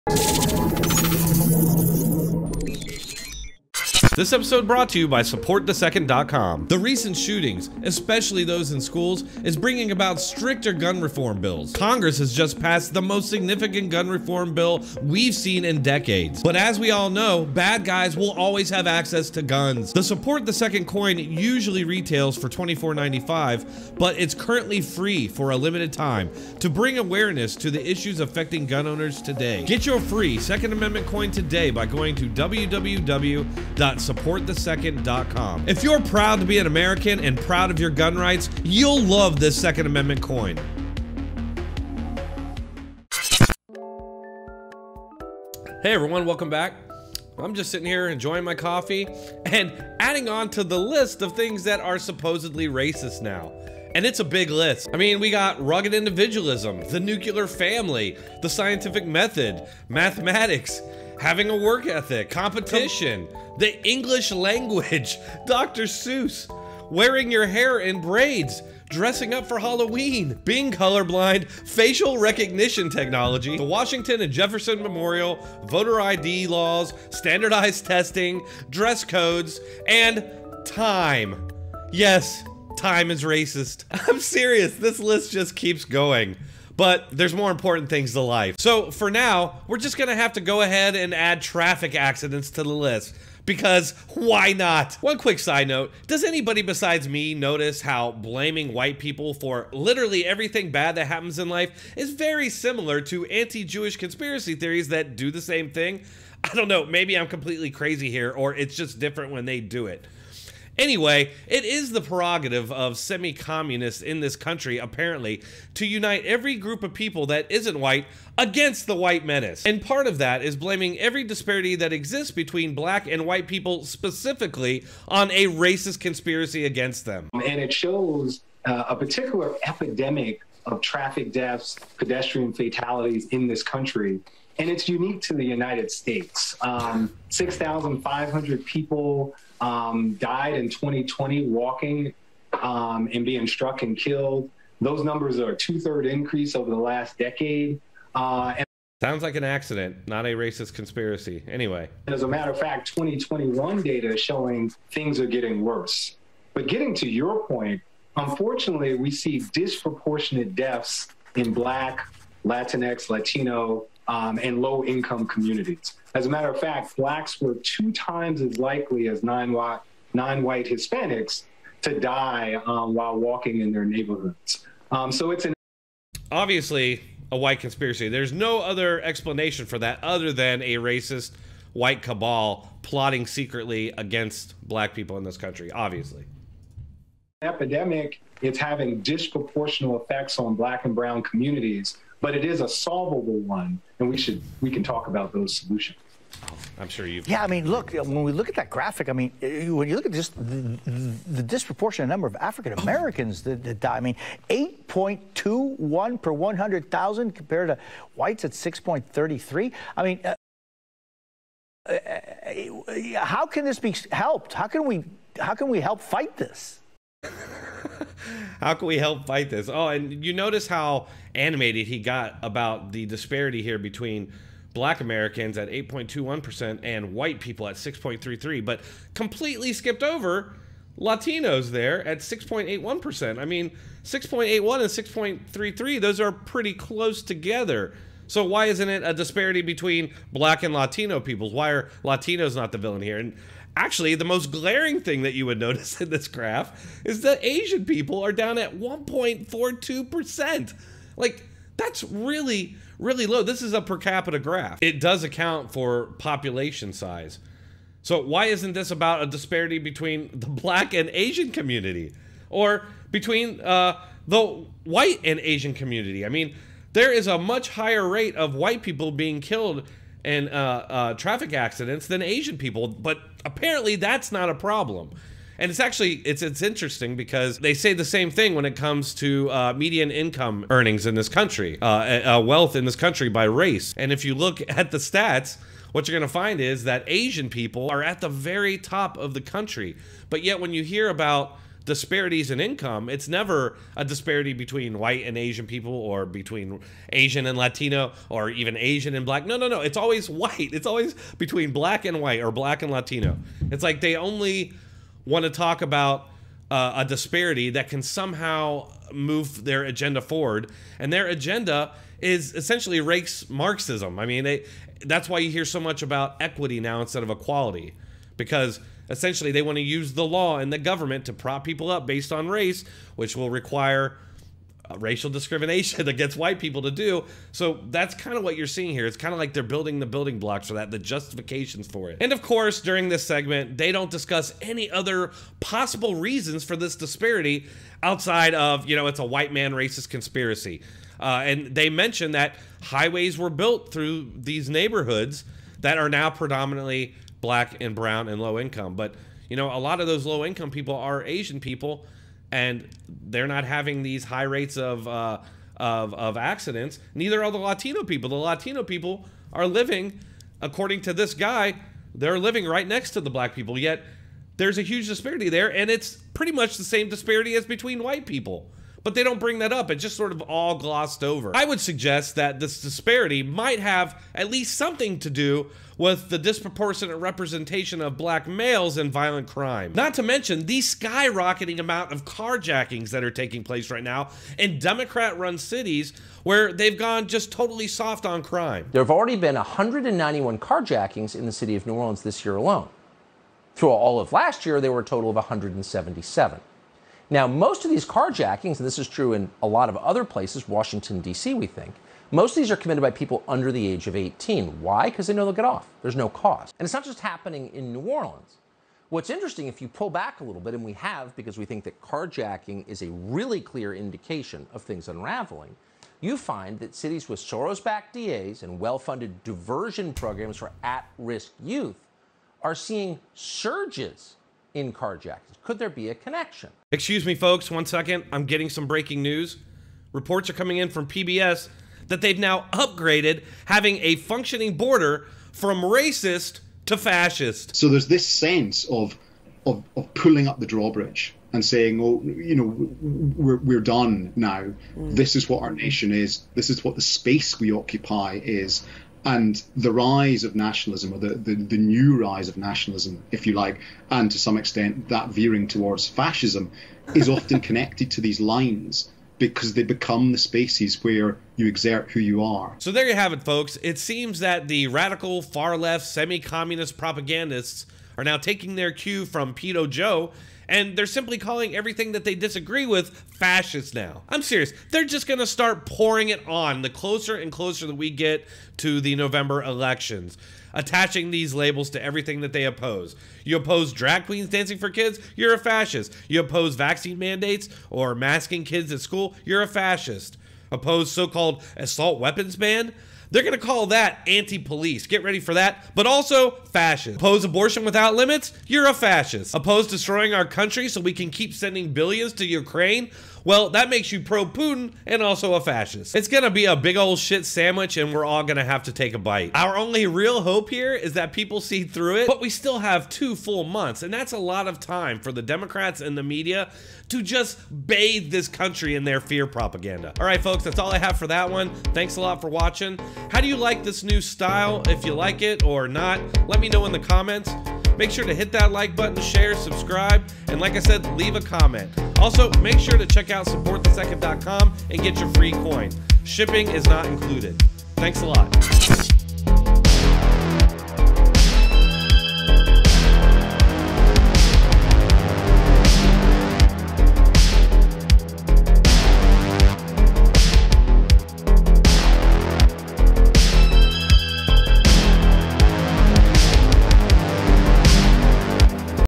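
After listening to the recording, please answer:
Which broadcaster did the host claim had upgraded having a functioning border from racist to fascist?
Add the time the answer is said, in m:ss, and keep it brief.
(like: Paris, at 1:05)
PBS, at 7:11.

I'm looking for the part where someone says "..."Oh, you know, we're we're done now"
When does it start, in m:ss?
7:22.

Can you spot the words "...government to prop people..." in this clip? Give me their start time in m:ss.
5:20.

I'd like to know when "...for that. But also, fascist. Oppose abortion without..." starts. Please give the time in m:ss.
8:15.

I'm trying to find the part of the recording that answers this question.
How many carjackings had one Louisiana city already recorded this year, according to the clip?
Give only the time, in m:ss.
6:29.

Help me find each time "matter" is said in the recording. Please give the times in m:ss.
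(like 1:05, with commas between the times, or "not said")
2:32, 2:46.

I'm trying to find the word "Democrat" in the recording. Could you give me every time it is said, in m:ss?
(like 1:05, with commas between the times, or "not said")
6:24, 8:35.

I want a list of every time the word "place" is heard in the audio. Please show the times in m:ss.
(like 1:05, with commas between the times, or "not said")
6:23, 6:40.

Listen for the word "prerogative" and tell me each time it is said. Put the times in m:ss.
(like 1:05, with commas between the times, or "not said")
1:52.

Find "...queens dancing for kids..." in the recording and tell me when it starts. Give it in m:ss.
8:04.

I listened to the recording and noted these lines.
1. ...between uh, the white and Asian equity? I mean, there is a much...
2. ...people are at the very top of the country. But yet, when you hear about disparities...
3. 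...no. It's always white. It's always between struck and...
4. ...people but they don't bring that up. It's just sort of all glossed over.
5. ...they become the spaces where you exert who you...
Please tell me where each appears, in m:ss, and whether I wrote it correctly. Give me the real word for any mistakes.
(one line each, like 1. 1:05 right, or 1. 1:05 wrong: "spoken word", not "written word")
1. 4:23 wrong: "community", not "equity"
2. 4:47 right
3. 4:59 wrong: "black", not "struck"
4. 6:08 right
5. 7:39 right.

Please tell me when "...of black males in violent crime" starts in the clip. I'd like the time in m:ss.
6:18.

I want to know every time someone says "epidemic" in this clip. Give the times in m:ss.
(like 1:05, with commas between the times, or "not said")
2:09, 3:07.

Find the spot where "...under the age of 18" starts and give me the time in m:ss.
6:43.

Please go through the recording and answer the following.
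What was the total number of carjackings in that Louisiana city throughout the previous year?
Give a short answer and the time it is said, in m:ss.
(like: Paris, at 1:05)
177, at 6:35.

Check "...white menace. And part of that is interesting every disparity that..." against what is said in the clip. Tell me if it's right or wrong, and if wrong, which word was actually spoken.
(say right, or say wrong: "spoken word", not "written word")
wrong: "blaming", not "interesting".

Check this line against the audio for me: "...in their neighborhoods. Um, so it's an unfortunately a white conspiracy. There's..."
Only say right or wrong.
wrong.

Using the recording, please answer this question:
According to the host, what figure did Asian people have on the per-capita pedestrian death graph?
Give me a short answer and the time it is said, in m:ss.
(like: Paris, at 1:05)
1.42, at 4:08.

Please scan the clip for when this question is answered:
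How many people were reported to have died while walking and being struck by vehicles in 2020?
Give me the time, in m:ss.
2:17.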